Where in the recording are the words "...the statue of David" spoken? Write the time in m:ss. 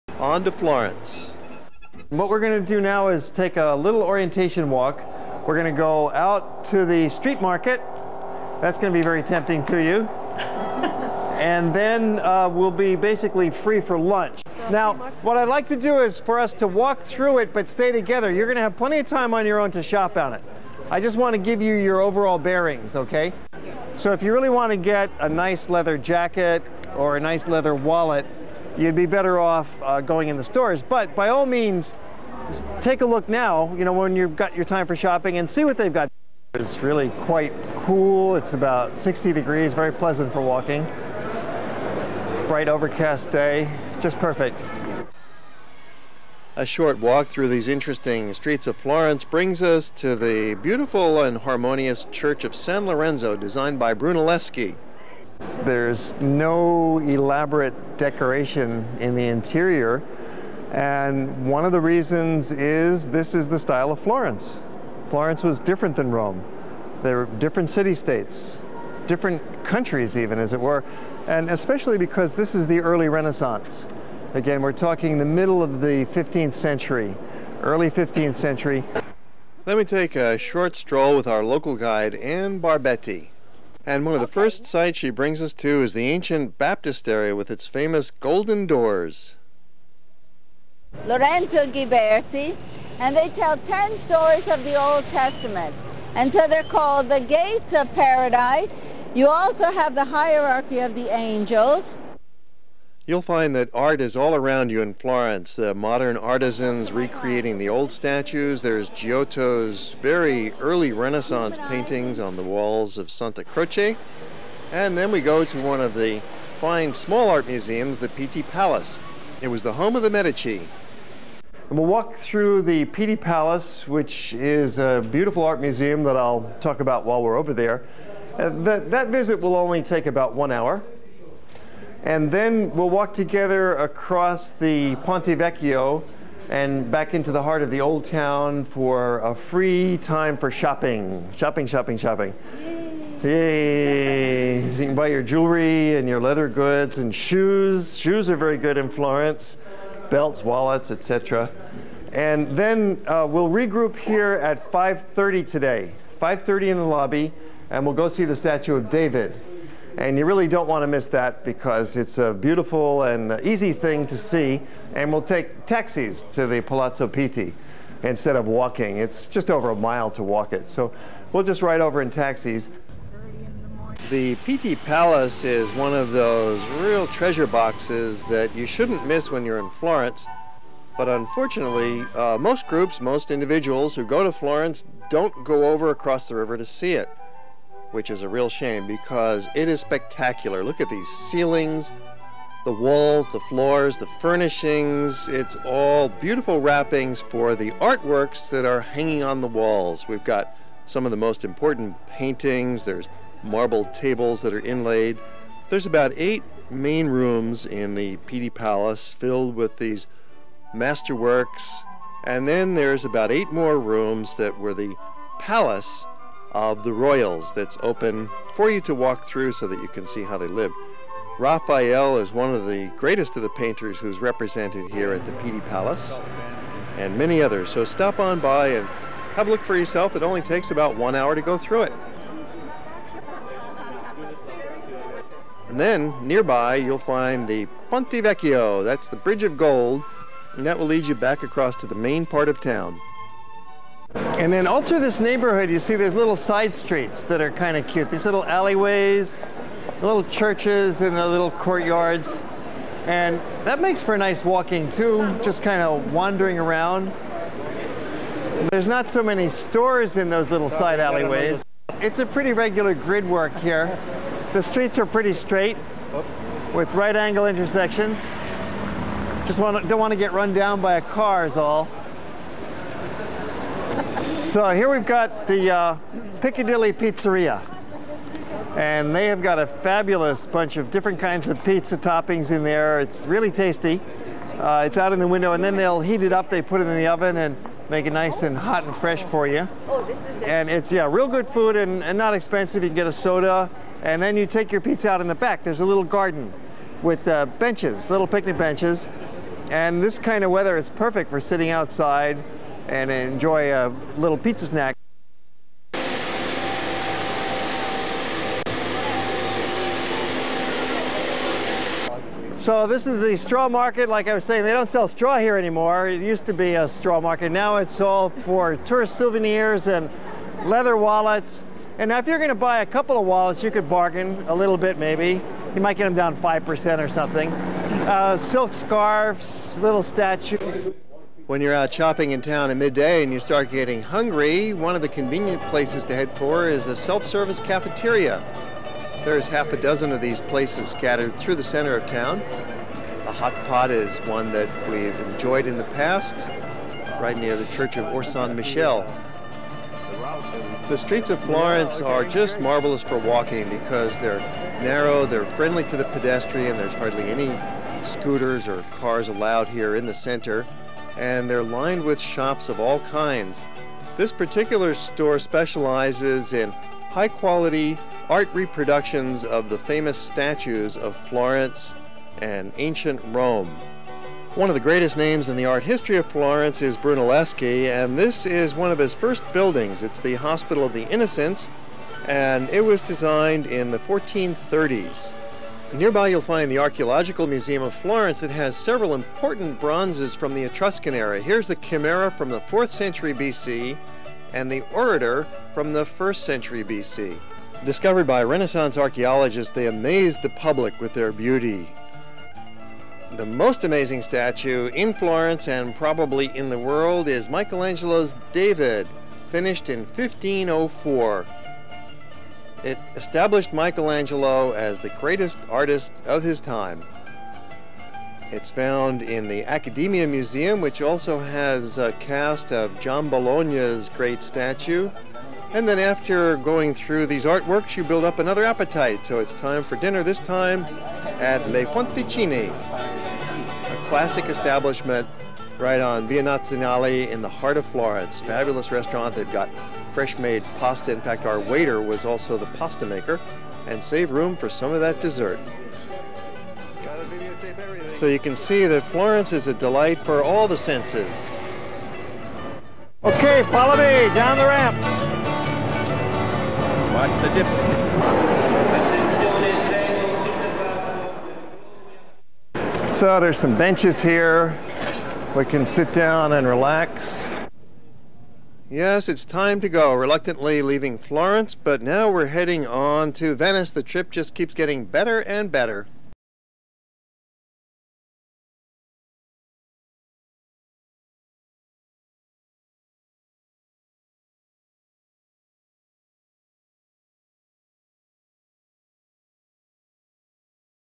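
2:38.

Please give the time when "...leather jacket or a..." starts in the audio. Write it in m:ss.
0:25.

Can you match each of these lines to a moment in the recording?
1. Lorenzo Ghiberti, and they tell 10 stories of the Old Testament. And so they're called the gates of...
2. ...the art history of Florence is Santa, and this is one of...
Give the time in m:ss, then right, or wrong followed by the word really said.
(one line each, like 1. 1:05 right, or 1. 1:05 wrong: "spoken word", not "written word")
1. 1:31 right
2. 6:15 wrong: "Brunelleschi", not "Santa".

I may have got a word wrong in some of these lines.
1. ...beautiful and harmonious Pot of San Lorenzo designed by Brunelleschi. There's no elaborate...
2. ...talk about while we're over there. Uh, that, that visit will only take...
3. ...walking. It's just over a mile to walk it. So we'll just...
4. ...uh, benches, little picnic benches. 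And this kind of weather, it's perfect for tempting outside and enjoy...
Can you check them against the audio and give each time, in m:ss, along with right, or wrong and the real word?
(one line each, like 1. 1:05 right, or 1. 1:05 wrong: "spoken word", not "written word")
1. 0:50 wrong: "Church", not "Pot"
2. 2:06 right
3. 2:48 right
4. 4:57 wrong: "sitting", not "tempting".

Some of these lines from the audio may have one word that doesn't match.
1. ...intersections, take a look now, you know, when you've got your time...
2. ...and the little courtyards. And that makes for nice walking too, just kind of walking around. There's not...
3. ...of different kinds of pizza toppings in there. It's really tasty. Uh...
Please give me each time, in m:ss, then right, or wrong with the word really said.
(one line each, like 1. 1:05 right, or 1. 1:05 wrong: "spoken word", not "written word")
1. 0:31 wrong: "means", not "intersections"
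2. 4:11 wrong: "wandering", not "walking"
3. 4:40 right.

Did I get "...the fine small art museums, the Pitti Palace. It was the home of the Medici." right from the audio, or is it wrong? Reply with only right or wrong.
right.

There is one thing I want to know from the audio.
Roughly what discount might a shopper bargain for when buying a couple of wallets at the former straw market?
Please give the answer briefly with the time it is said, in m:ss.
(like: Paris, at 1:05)
5%, at 5:26.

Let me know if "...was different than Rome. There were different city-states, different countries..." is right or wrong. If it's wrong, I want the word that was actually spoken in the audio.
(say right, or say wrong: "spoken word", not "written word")
right.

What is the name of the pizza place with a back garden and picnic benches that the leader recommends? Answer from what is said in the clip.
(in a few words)
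Piccadilly Pizzeria.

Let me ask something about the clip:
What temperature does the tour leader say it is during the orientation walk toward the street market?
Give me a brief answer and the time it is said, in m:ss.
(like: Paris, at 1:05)
60 degrees, at 0:38.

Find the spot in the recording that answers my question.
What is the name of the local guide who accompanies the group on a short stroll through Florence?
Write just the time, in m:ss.
1:22.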